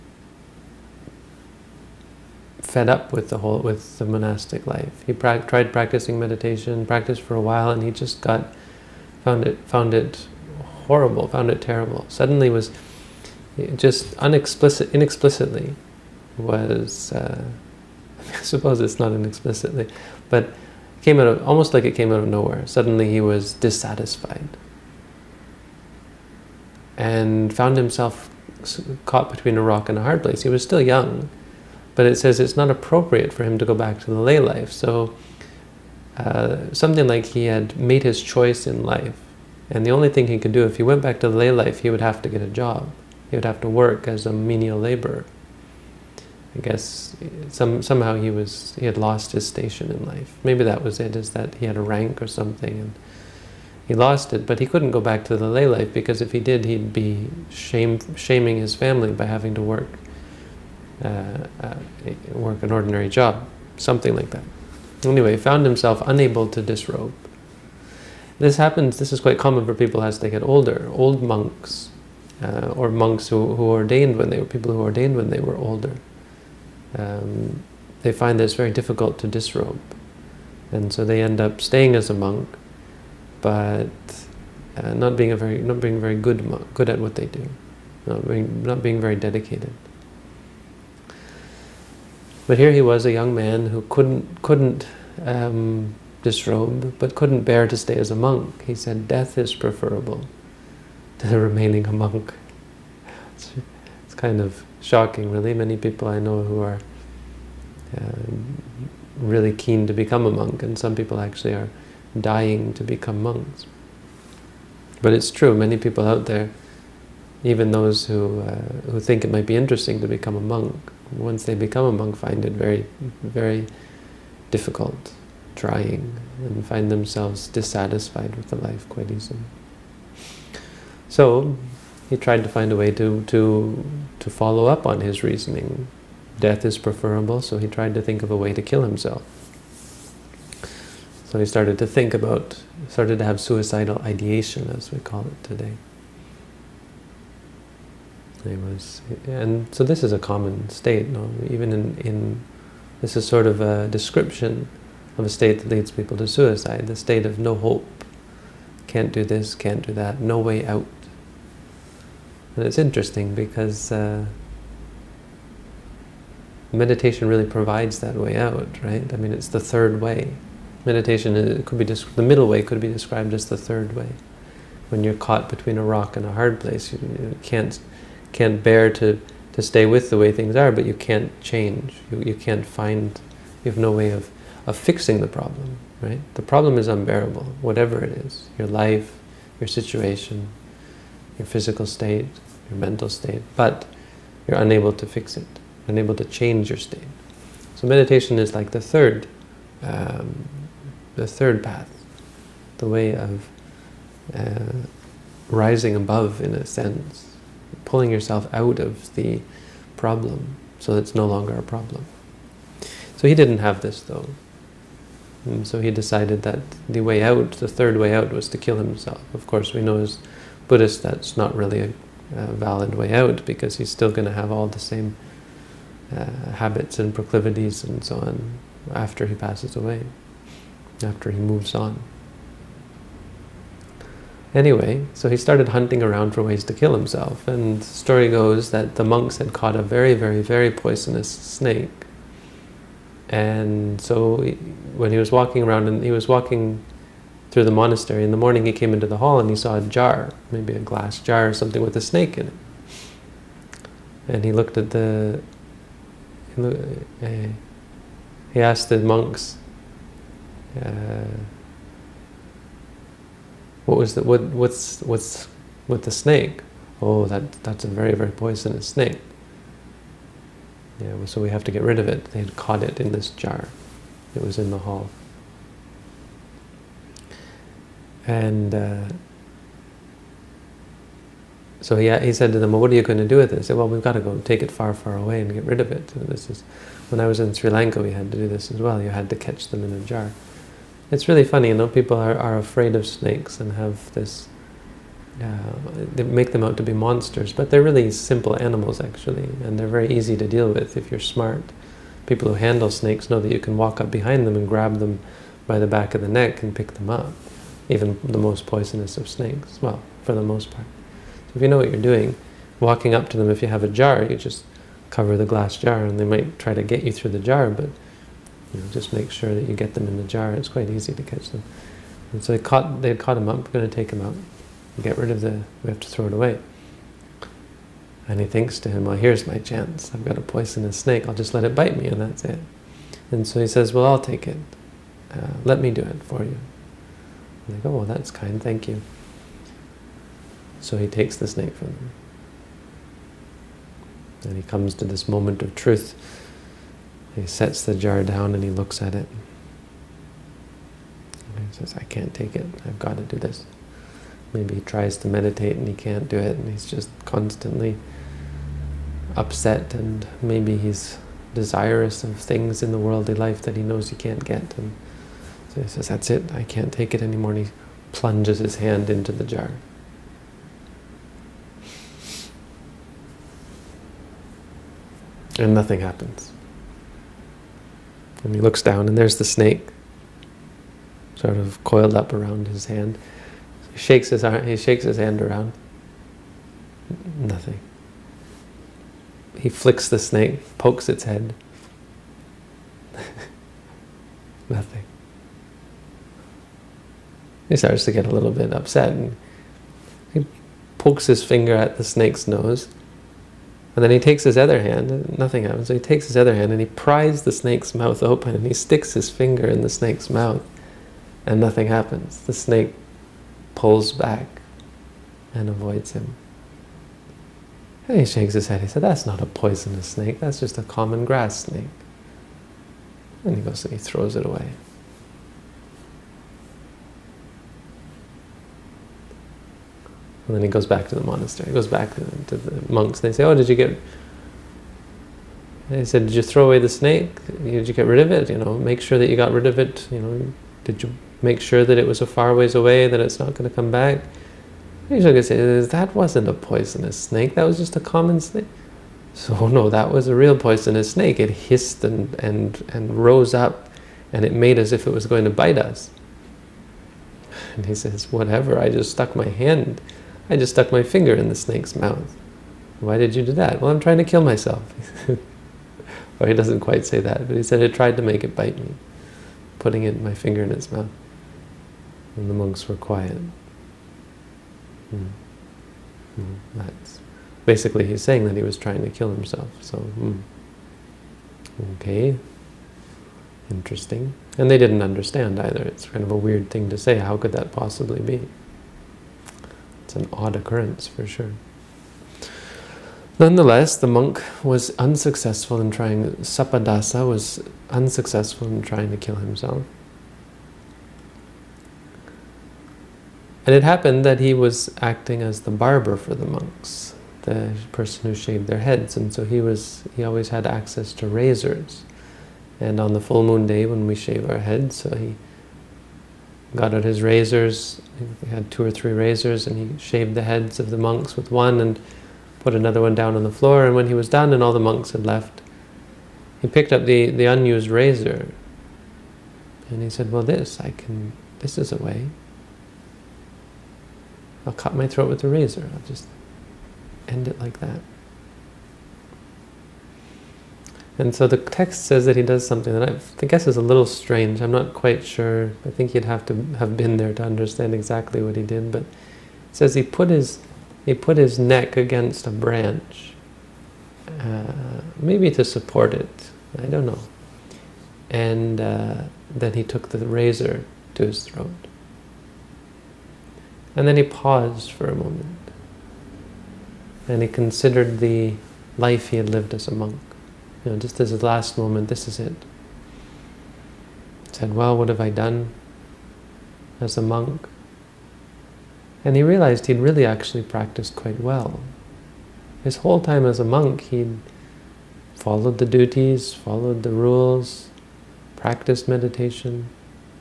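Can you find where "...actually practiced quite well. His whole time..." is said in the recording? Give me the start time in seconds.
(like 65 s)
580 s.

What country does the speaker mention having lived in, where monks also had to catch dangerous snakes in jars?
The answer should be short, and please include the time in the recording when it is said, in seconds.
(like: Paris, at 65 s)
Sri Lanka, at 287 s.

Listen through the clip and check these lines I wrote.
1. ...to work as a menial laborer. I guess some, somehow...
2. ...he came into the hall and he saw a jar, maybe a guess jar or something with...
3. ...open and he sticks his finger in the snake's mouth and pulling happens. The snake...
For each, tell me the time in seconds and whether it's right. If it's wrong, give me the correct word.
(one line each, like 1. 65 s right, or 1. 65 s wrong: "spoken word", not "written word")
1. 43 s right
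2. 248 s wrong: "glass", not "guess"
3. 408 s wrong: "nothing", not "pulling".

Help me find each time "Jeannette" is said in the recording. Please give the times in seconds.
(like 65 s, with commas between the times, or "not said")
not said.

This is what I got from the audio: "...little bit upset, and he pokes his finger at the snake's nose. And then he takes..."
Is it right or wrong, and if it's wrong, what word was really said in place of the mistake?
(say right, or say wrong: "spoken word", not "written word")
right.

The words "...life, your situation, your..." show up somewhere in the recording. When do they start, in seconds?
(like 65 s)
188 s.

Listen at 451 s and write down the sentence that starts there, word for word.
It hissed and, and, and rose up and it made as if it was going to bite us.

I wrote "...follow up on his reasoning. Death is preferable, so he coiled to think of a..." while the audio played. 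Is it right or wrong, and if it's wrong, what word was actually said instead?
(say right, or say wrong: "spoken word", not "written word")
wrong: "tried", not "coiled".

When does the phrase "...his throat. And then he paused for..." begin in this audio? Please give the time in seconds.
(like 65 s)
561 s.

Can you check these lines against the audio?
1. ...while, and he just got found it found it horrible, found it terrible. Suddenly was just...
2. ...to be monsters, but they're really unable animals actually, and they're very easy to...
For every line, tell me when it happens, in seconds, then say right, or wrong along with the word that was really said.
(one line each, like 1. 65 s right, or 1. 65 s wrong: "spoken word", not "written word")
1. 7 s right
2. 296 s wrong: "simple", not "unable".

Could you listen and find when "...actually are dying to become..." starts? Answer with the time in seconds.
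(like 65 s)
111 s.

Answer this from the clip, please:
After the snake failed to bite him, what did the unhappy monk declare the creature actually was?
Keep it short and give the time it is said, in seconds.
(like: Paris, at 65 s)
Common grass snake, at 420 s.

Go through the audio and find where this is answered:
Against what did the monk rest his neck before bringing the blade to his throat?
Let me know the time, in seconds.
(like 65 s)
552 s.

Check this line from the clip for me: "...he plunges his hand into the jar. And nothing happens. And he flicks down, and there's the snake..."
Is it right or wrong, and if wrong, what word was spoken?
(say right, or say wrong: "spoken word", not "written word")
wrong: "looks", not "flicks".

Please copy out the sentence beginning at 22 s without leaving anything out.
Suddenly he was dissatisfied and found himself caught between a rock and a hard place.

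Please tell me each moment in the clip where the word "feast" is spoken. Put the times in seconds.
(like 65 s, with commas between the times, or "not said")
not said.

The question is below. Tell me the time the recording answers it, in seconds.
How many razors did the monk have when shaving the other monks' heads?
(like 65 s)
518 s.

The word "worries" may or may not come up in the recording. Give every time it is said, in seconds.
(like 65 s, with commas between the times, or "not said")
not said.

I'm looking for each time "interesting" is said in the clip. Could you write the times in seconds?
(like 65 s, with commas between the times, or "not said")
119 s, 162 s, 483 s.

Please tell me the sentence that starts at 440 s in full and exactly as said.
You know, did you make sure that it was a far ways away, that it's not going to come back?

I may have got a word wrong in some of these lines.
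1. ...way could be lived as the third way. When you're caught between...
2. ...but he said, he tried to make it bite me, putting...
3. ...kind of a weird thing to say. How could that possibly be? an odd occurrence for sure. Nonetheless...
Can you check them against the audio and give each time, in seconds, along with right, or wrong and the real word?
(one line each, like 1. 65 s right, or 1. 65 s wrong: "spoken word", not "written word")
1. 172 s wrong: "described", not "lived"
2. 467 s right
3. 486 s right.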